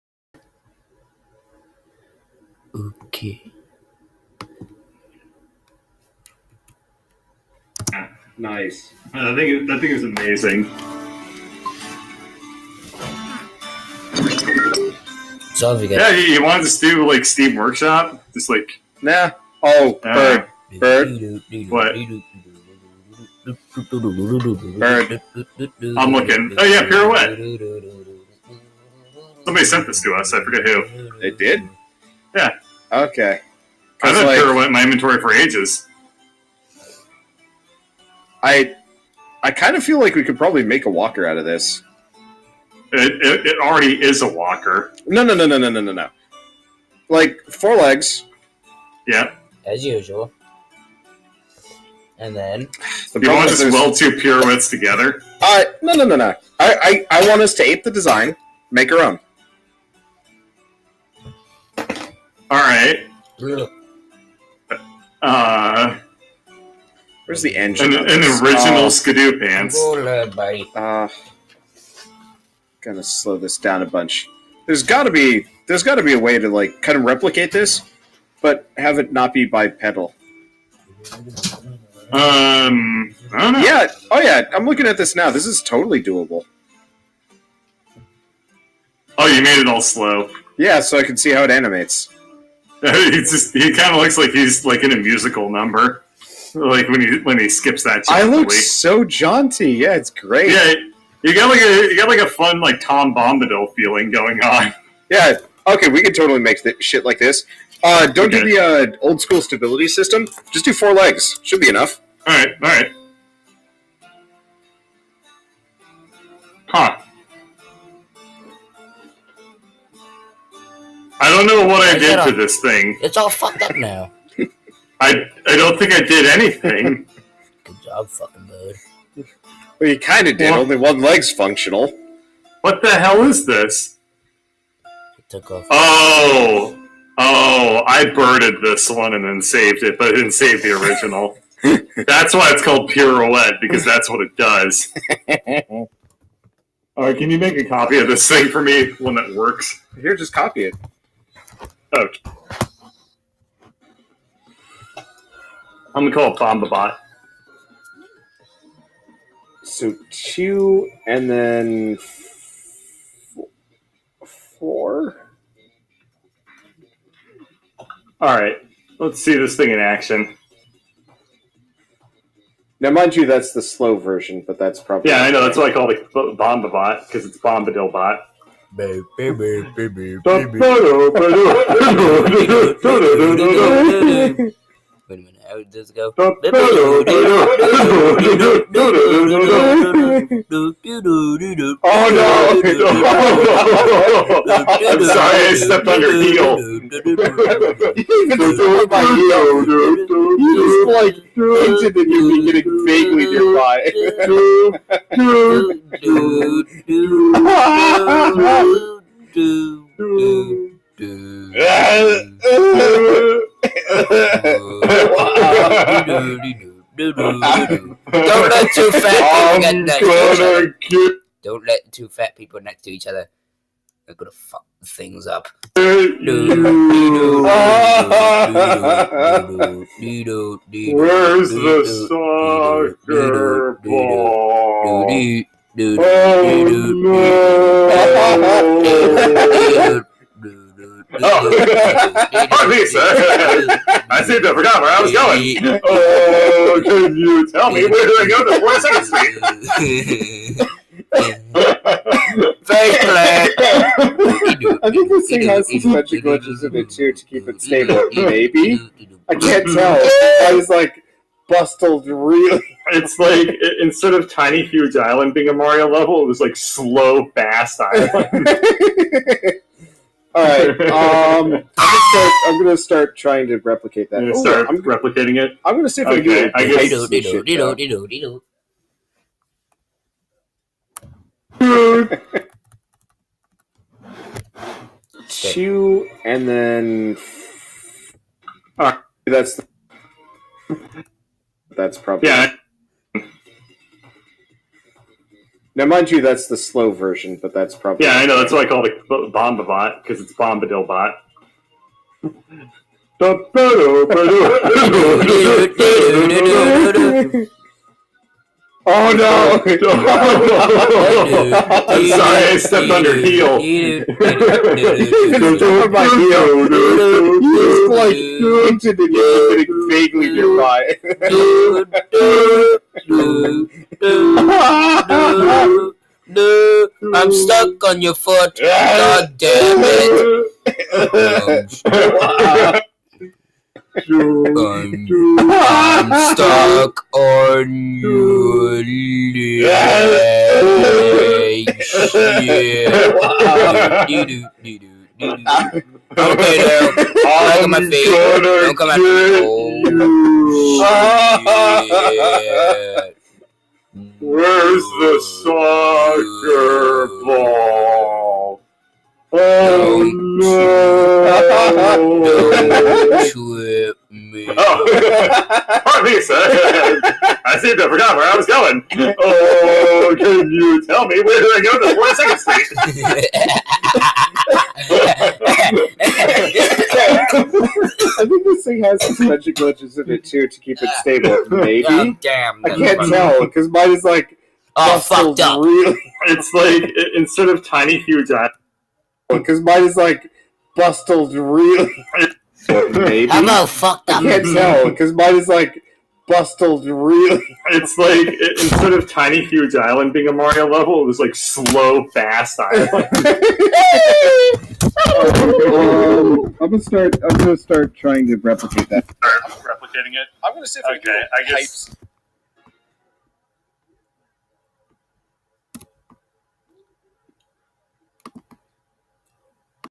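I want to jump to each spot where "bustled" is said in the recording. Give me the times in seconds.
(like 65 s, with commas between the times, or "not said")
261 s, 390 s, 396 s.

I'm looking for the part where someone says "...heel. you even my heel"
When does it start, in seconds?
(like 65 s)
196 s.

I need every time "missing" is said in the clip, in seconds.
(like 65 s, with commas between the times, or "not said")
not said.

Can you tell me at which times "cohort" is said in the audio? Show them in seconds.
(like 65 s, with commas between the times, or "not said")
not said.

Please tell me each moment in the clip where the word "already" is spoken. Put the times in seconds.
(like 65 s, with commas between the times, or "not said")
43 s.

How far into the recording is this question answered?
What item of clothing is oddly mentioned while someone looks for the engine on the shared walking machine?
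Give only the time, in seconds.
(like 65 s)
68 s.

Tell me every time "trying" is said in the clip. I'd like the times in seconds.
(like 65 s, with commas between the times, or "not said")
273 s, 407 s.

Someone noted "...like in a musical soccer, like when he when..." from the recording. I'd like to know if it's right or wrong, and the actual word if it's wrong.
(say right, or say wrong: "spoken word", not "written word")
wrong: "number", not "soccer".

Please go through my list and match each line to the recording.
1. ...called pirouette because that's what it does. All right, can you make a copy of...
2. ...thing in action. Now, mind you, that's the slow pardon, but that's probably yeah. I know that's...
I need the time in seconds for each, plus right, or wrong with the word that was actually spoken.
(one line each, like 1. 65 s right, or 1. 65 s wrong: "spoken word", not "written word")
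1. 142 s right
2. 169 s wrong: "version", not "pardon".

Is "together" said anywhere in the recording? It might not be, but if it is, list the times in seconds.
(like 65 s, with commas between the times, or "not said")
54 s.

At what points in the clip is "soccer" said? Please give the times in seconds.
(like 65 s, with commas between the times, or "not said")
232 s, 355 s.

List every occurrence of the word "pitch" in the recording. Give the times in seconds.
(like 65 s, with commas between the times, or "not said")
not said.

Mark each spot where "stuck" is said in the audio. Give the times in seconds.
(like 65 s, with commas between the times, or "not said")
327 s, 336 s.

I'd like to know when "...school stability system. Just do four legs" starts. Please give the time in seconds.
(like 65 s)
109 s.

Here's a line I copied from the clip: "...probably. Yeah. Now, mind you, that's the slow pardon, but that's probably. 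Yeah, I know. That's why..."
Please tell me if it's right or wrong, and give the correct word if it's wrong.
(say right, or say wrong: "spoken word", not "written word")
wrong: "version", not "pardon".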